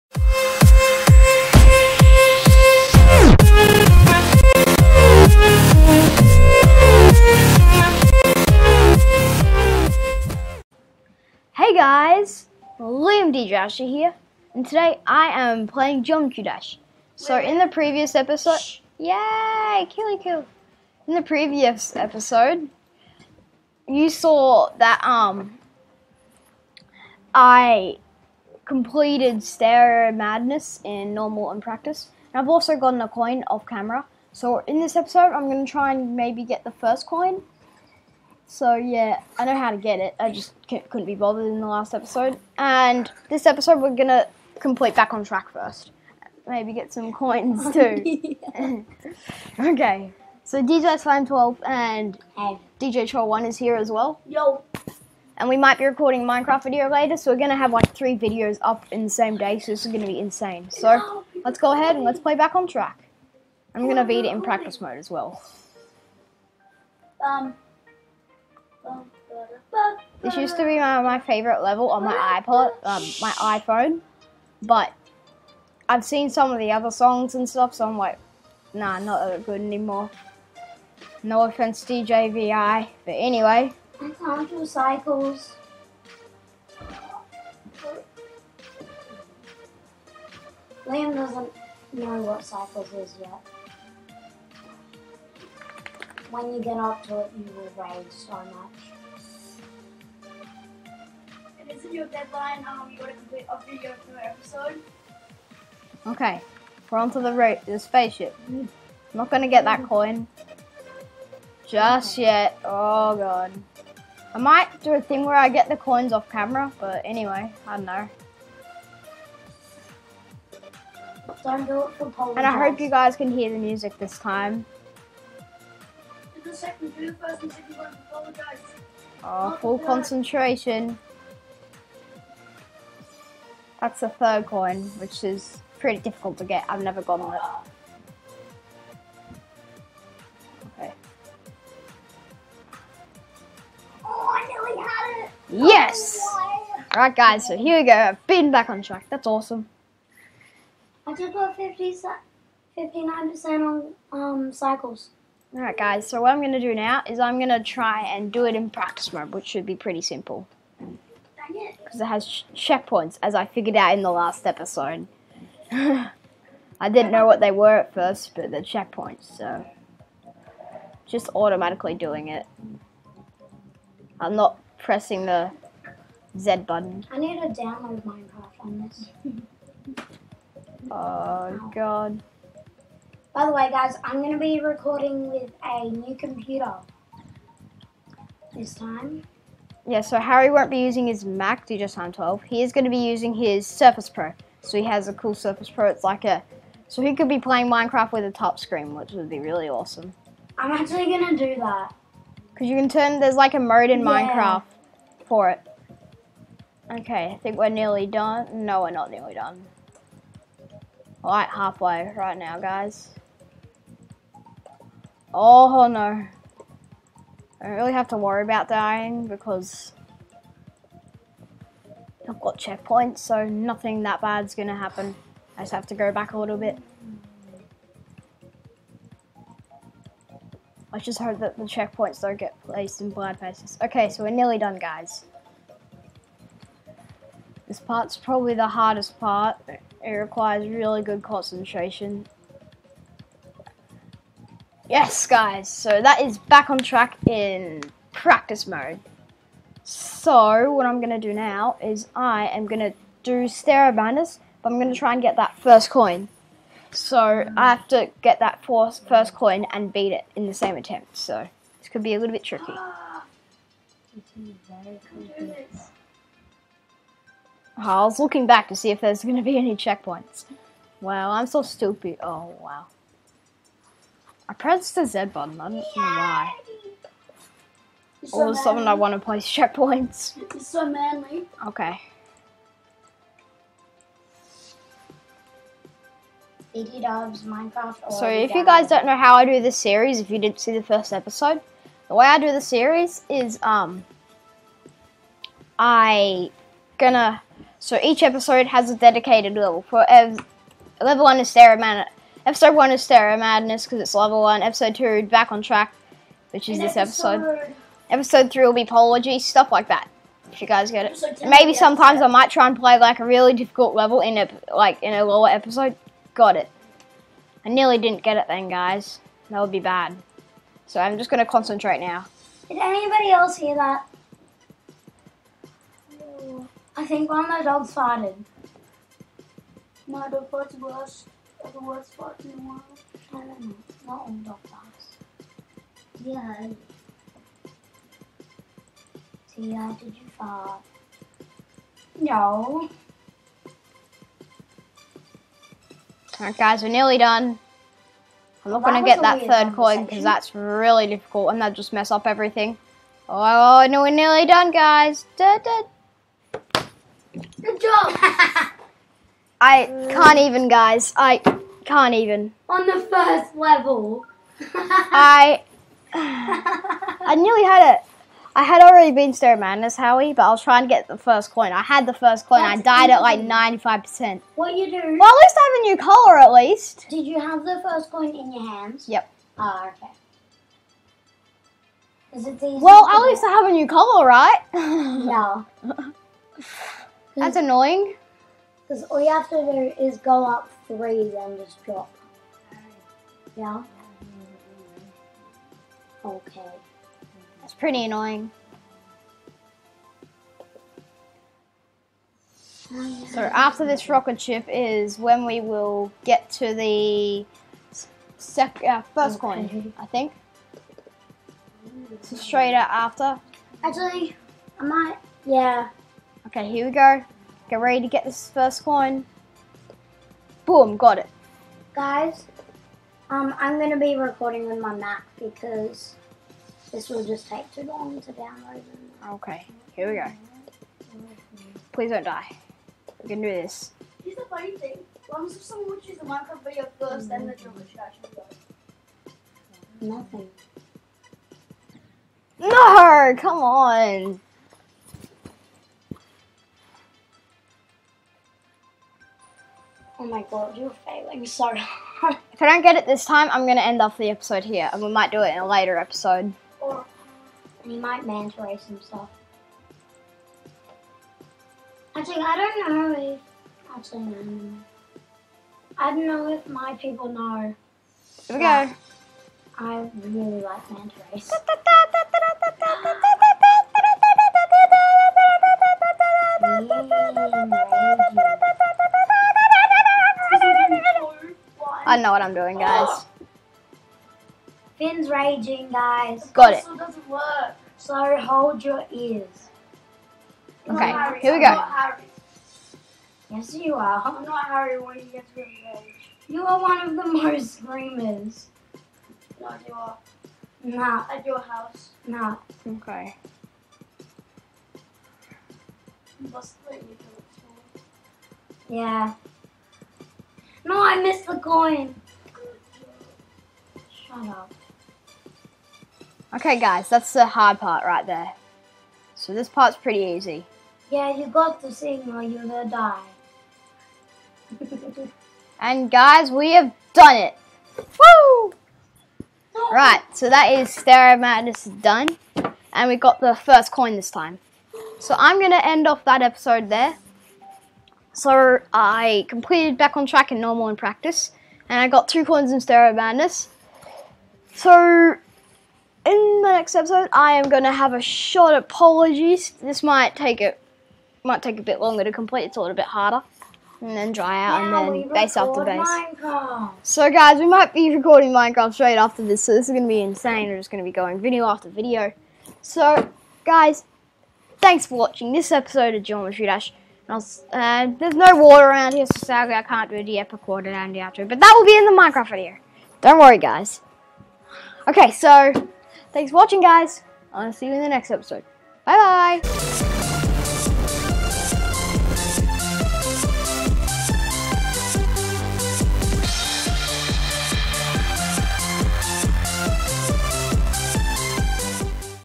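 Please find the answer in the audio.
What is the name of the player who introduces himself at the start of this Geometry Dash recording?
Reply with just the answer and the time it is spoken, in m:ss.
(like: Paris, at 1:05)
Joshua, at 0:13.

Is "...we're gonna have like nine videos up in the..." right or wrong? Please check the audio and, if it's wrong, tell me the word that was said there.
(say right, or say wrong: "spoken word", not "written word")
wrong: "three", not "nine".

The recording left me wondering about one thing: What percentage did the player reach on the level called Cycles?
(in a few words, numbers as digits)
59%.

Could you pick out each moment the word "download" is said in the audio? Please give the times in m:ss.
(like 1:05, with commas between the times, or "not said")
2:57, 7:08.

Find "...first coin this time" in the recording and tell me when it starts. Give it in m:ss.
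8:53.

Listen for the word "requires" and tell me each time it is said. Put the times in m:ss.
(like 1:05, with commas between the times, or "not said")
4:00.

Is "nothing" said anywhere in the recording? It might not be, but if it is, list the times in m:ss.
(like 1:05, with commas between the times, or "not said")
3:43, 7:20.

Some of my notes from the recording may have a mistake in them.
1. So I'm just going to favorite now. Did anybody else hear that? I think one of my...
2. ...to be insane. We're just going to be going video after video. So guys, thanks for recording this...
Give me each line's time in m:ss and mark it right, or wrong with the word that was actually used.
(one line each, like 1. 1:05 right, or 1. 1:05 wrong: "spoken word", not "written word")
1. 5:20 wrong: "concentrate", not "favorite"
2. 9:20 wrong: "watching", not "recording".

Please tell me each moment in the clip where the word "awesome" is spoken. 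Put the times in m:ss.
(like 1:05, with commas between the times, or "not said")
2:29, 3:19.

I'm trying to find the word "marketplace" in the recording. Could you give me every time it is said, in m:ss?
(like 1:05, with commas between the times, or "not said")
not said.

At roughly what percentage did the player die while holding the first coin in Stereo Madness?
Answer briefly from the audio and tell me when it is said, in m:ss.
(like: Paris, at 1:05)
95%, at 6:13.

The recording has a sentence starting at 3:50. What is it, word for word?
I just hope that the checkpoints don't get placed in blind places.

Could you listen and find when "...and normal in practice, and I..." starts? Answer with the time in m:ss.
9:00.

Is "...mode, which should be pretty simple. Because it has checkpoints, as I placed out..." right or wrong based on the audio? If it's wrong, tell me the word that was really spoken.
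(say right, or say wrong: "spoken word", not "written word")
wrong: "figured", not "placed".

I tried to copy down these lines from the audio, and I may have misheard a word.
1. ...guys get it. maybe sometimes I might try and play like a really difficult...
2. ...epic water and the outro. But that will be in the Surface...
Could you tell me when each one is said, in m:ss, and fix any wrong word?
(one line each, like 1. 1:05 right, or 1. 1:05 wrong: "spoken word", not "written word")
1. 5:10 right
2. 9:30 wrong: "Minecraft", not "Surface".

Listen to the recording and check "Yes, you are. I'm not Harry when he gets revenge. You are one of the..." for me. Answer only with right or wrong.
right.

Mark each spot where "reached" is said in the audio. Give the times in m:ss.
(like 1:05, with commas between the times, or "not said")
not said.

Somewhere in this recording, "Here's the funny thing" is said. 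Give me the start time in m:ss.
7:14.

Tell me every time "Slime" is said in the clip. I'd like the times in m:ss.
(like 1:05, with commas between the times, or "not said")
0:50.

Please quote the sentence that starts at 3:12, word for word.
He is going to be using his Surface Pro.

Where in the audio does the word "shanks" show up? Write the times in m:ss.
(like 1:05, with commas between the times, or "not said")
not said.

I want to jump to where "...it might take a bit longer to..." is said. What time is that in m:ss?
9:10.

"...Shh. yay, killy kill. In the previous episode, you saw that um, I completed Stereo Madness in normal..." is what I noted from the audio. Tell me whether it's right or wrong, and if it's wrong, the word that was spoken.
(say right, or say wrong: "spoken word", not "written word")
right.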